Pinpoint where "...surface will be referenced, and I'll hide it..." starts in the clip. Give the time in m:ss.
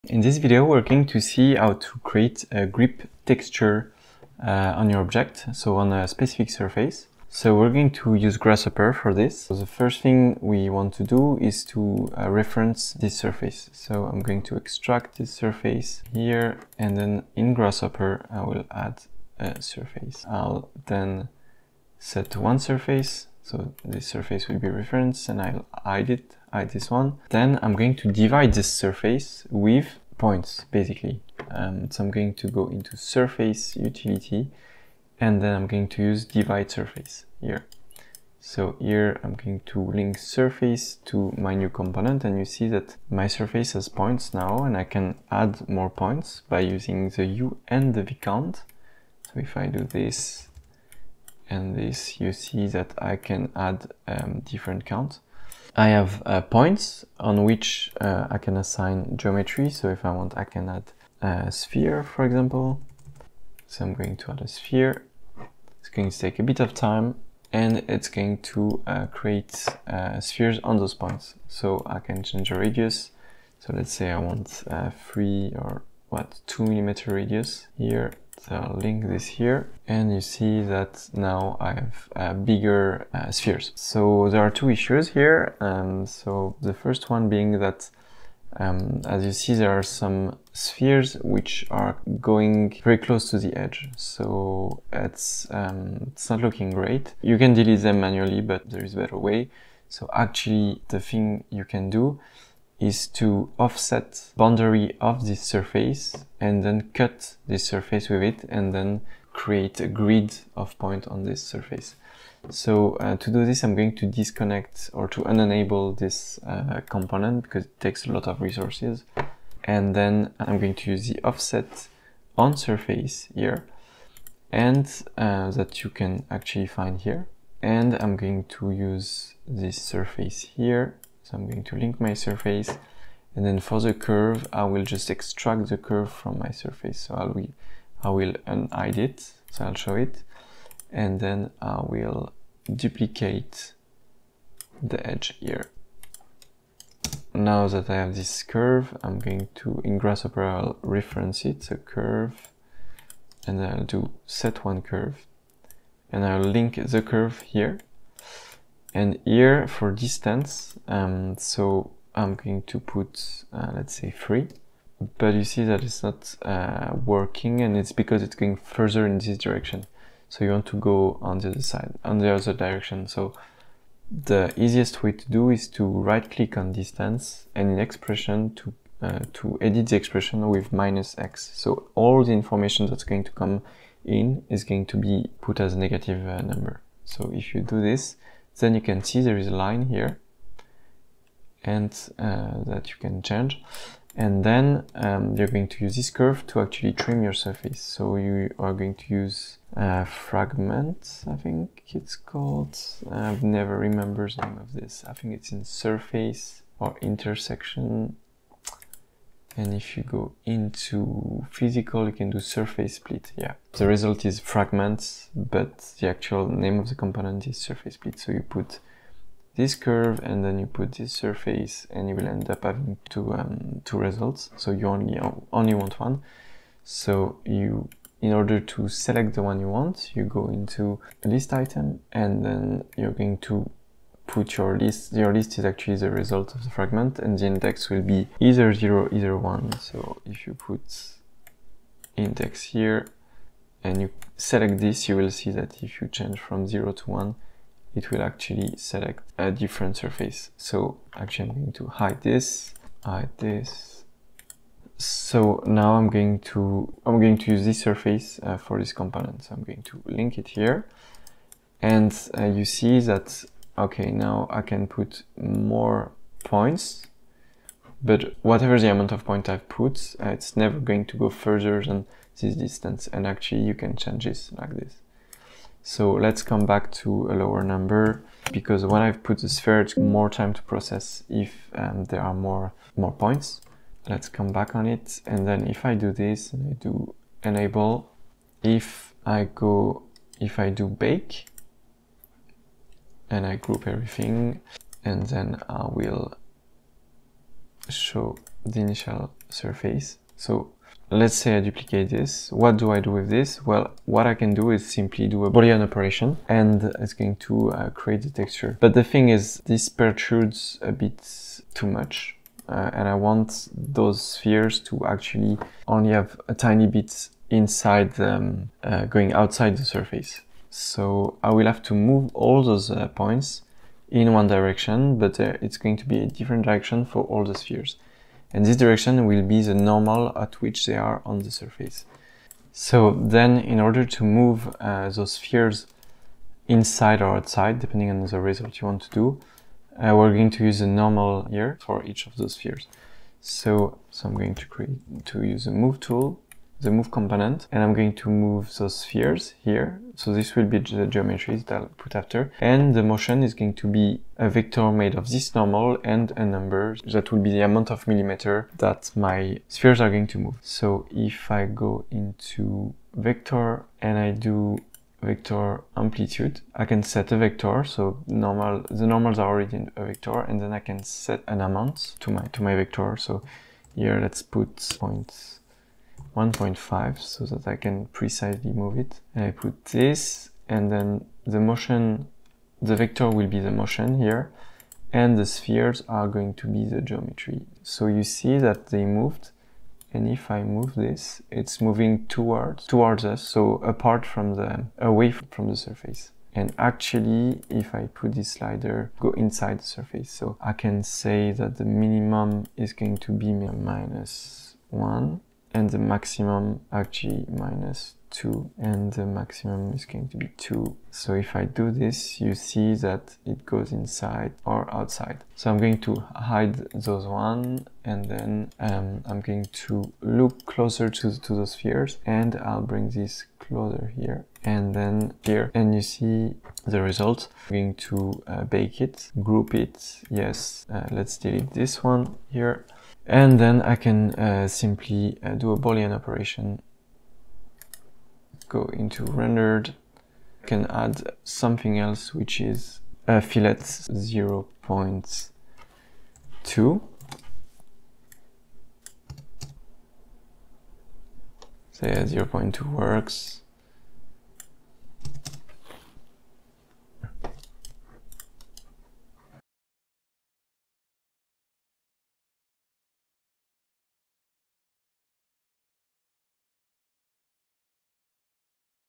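0:24.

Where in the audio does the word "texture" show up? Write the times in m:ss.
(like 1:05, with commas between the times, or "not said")
0:03, 5:08.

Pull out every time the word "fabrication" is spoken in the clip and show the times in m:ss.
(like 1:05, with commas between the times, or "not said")
not said.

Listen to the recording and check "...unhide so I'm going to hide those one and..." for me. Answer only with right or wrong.
wrong.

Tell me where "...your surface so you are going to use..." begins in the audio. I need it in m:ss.
3:17.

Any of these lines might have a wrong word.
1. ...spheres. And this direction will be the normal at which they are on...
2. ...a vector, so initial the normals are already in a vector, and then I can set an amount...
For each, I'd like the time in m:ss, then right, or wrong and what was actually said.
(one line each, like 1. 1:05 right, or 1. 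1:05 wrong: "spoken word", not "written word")
1. 5:27 right
2. 6:07 wrong: "normal", not "initial".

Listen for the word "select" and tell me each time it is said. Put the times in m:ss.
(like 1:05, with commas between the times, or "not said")
3:48, 4:04, 4:08.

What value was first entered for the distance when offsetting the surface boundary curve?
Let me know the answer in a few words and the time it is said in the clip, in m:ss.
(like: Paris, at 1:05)
3, at 2:43.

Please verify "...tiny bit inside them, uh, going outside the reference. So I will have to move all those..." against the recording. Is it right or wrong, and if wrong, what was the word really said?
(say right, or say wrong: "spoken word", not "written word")
wrong: "surface", not "reference".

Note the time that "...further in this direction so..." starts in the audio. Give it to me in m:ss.
2:48.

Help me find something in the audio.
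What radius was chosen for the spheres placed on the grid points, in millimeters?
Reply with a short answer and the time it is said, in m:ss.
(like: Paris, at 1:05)
2, at 1:16.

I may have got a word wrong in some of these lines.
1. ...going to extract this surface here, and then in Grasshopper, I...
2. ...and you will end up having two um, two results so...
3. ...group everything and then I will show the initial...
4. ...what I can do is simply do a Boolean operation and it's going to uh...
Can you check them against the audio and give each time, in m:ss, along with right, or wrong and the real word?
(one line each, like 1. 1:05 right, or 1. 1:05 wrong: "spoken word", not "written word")
1. 0:14 right
2. 3:41 right
3. 4:53 right
4. 5:04 right.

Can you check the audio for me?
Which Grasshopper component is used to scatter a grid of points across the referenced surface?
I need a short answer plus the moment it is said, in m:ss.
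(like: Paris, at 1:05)
divide surface, at 0:36.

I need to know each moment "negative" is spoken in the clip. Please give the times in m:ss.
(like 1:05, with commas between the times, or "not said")
3:05.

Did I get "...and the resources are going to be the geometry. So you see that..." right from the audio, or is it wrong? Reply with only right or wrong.
wrong.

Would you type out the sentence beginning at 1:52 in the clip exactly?
So uh, to do this, I'm going to disconnect or to unenable this uh, component because it takes a lot of resources.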